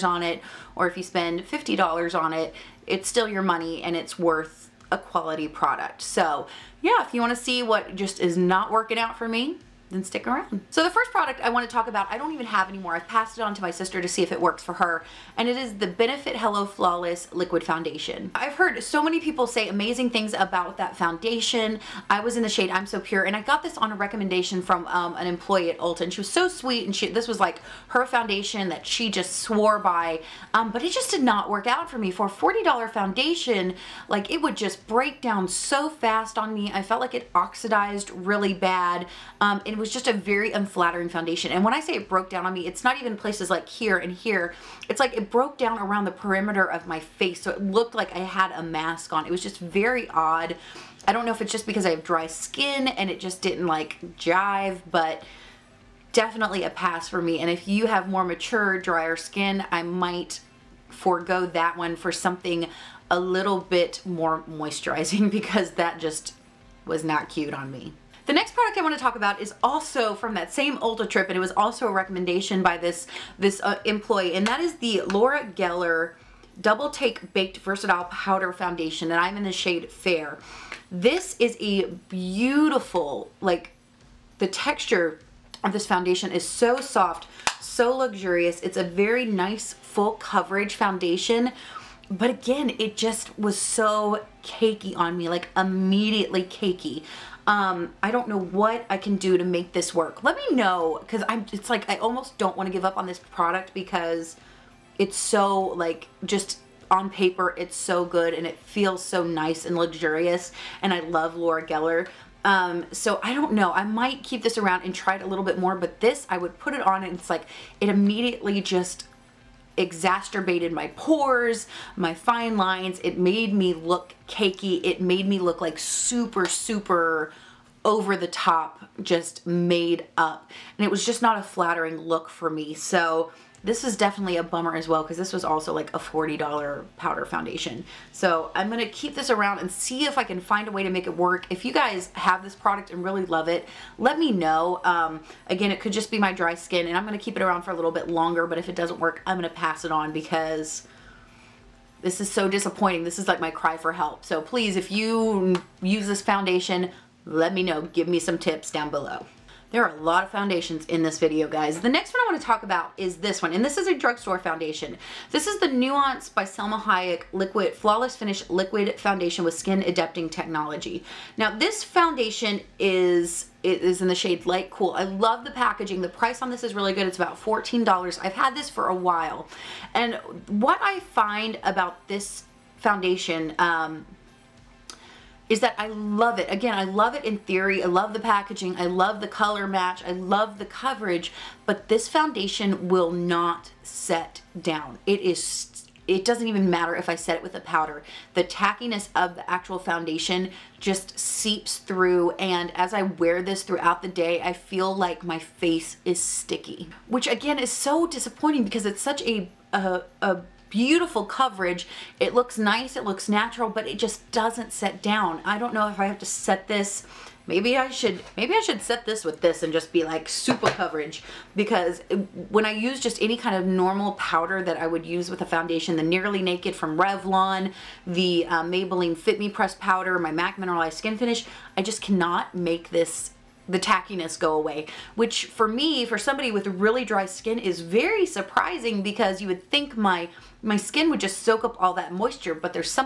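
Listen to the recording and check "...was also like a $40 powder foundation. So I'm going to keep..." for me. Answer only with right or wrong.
right.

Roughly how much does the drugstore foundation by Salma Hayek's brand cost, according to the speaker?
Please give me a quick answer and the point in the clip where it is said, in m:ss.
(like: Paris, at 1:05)
$14, at 2:57.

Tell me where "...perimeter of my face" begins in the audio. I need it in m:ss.
0:46.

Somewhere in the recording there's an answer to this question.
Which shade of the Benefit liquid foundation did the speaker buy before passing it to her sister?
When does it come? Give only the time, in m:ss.
0:22.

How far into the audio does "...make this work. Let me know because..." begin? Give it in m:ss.
1:39.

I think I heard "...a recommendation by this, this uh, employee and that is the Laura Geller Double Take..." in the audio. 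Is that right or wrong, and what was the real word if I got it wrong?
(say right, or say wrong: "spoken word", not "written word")
right.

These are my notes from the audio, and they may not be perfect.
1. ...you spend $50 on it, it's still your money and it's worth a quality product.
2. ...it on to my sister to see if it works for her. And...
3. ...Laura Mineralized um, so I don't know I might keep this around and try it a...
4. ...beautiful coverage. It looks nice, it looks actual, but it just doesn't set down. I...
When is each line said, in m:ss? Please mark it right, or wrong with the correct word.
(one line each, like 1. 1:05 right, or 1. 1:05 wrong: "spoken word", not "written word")
1. 0:00 right
2. 0:13 right
3. 1:51 wrong: "Geller", not "Mineralized"
4. 3:30 wrong: "natural", not "actual".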